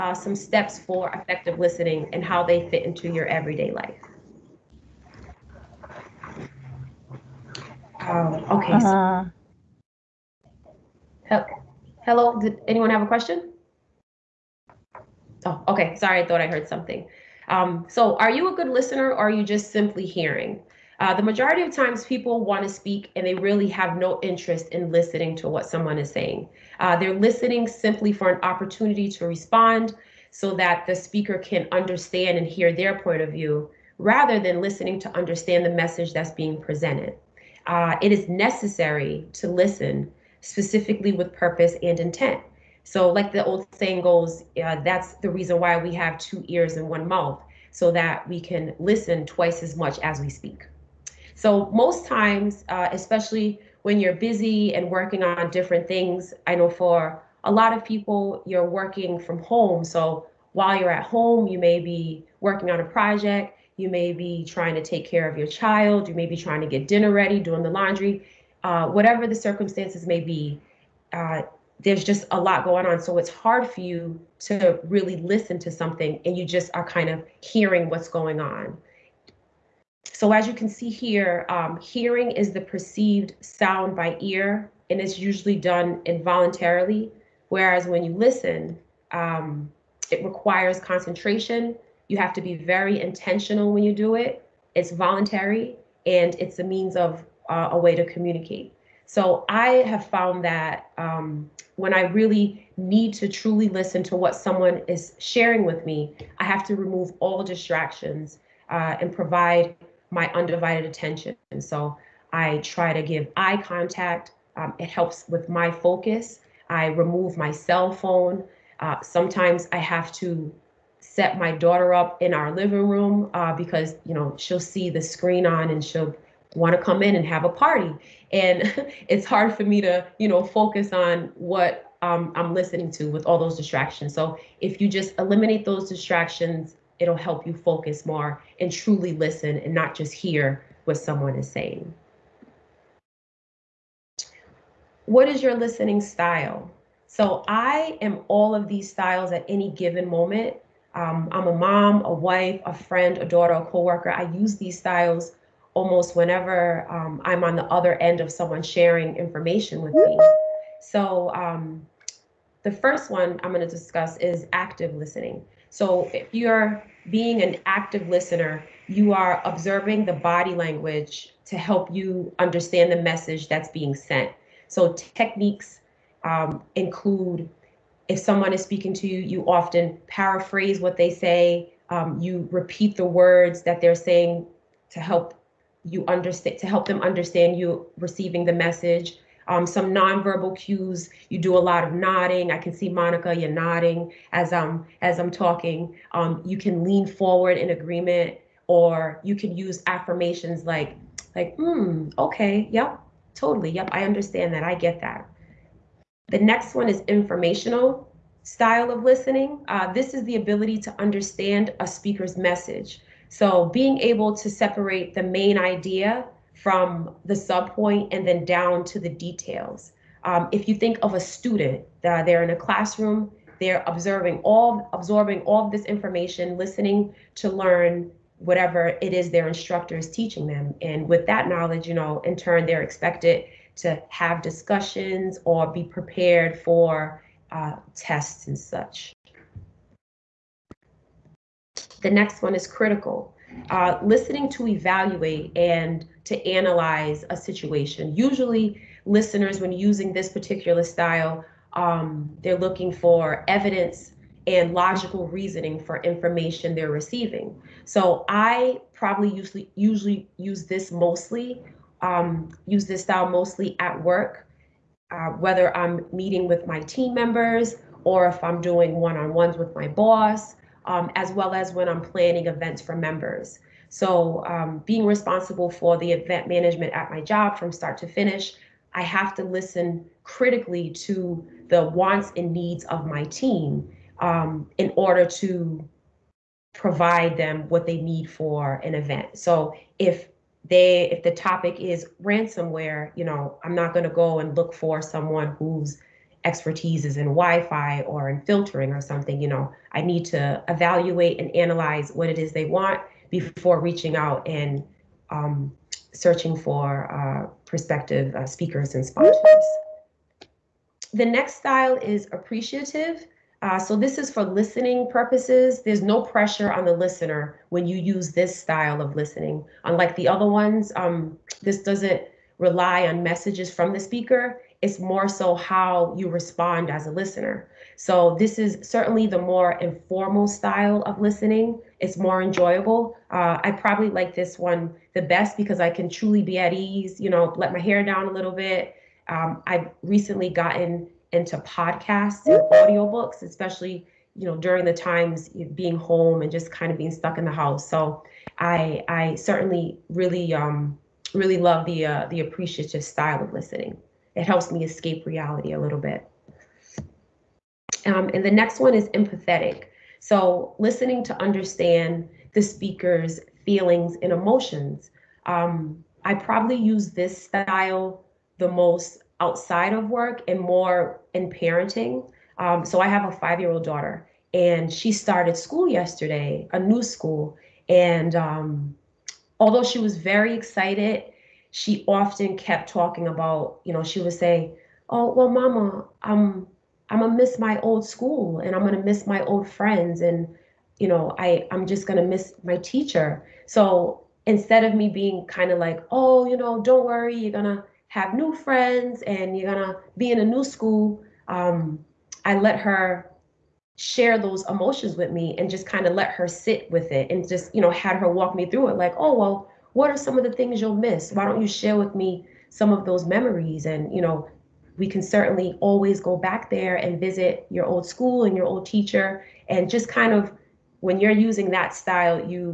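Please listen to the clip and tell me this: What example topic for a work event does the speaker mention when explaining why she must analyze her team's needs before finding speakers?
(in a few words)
ransomware.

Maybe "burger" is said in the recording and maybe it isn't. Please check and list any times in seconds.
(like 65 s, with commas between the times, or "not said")
not said.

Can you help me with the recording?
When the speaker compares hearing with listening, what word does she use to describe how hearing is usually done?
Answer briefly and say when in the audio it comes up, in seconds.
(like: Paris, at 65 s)
involuntarily, at 86 s.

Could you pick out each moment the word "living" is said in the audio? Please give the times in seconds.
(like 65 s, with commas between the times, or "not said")
122 s.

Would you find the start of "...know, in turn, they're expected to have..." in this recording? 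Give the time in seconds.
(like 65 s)
231 s.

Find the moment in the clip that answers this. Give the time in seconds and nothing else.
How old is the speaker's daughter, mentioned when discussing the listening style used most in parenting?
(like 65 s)
373 s.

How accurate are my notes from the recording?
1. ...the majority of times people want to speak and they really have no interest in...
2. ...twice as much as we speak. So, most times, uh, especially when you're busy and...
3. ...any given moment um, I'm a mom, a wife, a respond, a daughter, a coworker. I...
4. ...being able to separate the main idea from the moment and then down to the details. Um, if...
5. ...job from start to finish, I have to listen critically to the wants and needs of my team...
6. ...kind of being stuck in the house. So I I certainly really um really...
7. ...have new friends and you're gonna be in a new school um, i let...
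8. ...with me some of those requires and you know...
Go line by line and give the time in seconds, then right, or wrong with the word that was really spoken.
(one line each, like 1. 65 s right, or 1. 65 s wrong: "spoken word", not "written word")
1. 21 s right
2. 49 s right
3. 149 s wrong: "friend", not "respond"
4. 213 s wrong: "subpoint", not "moment"
5. 277 s right
6. 346 s right
7. 398 s right
8. 411 s wrong: "memories", not "requires".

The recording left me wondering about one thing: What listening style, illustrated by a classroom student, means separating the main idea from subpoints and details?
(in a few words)
informational.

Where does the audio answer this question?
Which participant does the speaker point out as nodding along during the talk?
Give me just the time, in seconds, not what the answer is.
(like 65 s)
192 s.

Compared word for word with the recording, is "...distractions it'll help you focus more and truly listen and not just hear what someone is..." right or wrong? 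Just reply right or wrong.
right.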